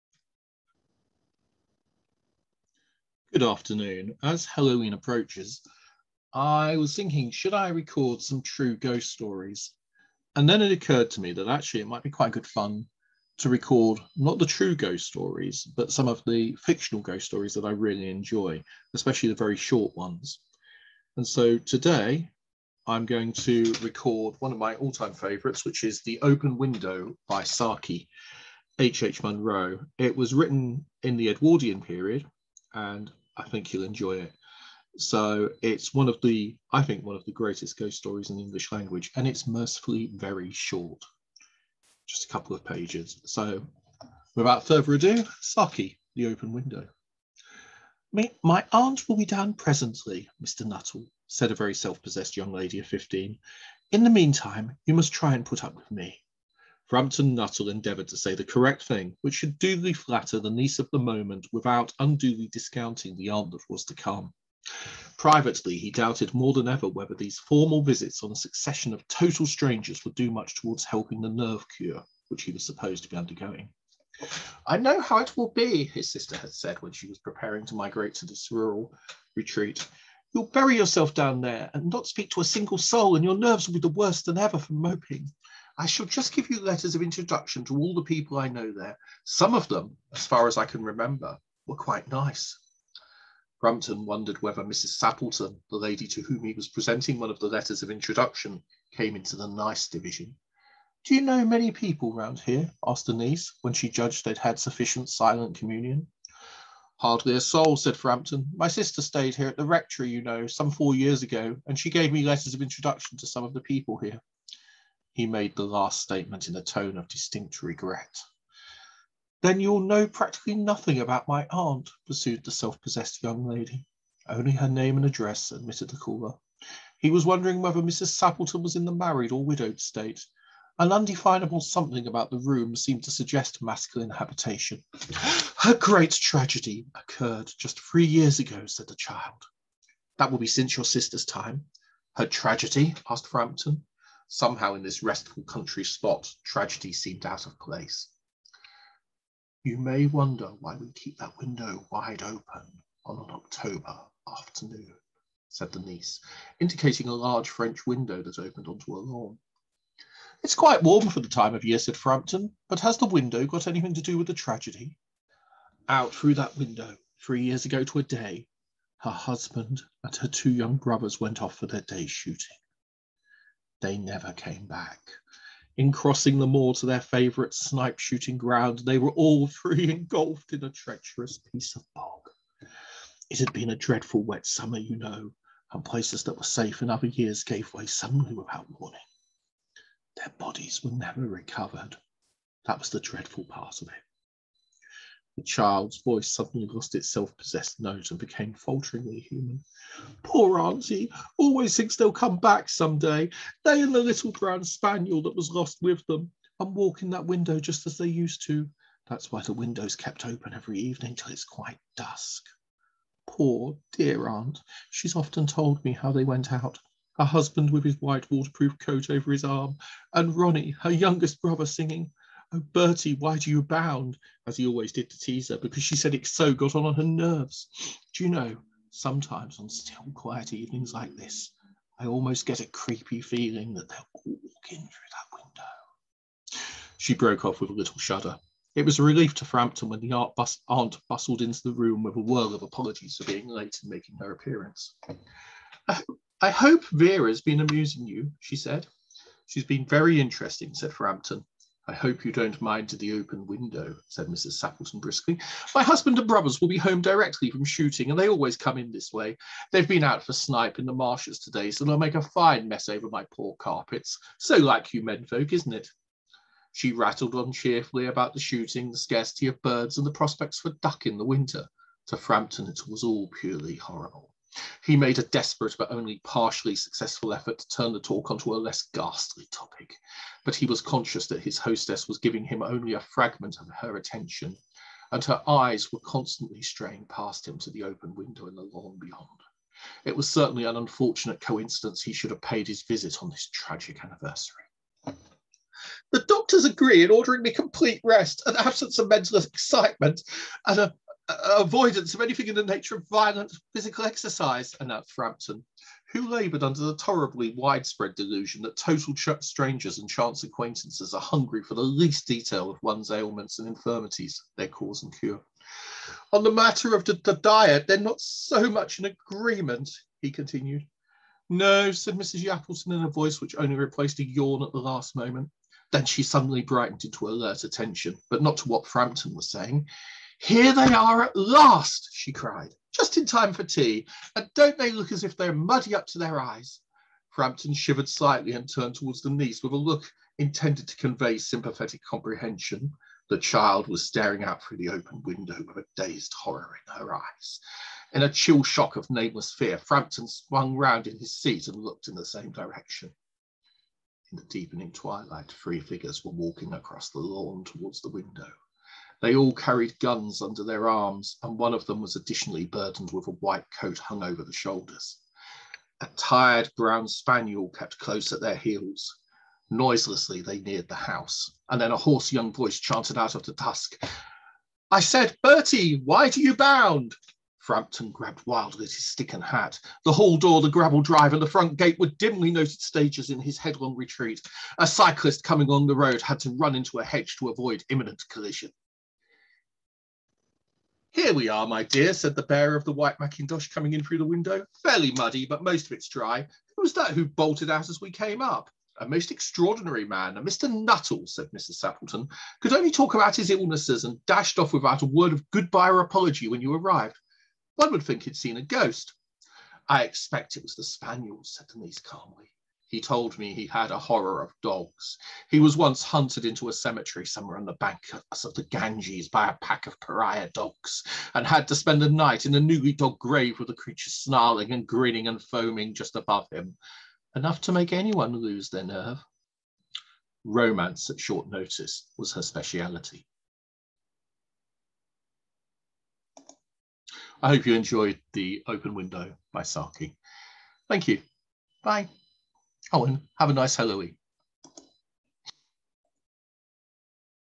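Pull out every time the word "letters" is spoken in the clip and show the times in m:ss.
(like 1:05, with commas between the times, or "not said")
1:26, 1:37, 1:52.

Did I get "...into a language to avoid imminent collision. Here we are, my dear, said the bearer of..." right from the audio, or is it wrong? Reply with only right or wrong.
wrong.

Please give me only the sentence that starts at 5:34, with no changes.
And don't they look as if they're muddy up to their eyes?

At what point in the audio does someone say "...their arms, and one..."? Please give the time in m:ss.
6:00.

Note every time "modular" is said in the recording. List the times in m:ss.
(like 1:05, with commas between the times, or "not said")
not said.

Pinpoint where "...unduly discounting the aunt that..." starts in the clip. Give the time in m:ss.
1:01.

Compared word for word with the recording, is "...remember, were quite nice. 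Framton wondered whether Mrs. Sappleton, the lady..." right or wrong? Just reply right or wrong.
right.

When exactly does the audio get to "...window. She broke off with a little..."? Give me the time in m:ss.
3:55.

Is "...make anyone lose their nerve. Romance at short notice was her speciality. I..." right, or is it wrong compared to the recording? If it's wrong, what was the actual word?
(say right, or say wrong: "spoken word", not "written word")
right.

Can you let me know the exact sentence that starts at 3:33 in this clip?
Poor dear aunt, she's often told me how they went out.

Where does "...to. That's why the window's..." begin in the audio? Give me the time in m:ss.
3:28.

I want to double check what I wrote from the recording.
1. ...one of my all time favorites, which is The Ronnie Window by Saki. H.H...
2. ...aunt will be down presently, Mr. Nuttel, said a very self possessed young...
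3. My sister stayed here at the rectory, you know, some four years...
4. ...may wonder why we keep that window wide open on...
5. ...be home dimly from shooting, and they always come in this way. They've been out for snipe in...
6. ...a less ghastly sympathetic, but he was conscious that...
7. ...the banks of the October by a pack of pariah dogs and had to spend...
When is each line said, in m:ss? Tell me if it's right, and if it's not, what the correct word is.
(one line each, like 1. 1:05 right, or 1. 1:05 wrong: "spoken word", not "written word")
1. 0:24 wrong: "Open", not "Ronnie"
2. 0:48 right
3. 1:48 right
4. 2:29 right
5. 4:16 wrong: "directly", not "dimly"
6. 4:38 wrong: "topic", not "sympathetic"
7. 6:57 wrong: "Ganges", not "October".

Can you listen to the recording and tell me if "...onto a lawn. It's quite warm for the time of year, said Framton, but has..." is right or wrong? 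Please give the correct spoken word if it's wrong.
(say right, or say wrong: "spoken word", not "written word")
right.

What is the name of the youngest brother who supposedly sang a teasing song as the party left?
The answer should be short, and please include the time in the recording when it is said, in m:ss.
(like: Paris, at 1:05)
Ronnie, at 3:40.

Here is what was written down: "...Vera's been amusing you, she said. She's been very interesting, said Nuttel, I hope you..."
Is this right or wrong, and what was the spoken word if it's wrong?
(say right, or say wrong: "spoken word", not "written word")
wrong: "Framton", not "Nuttel".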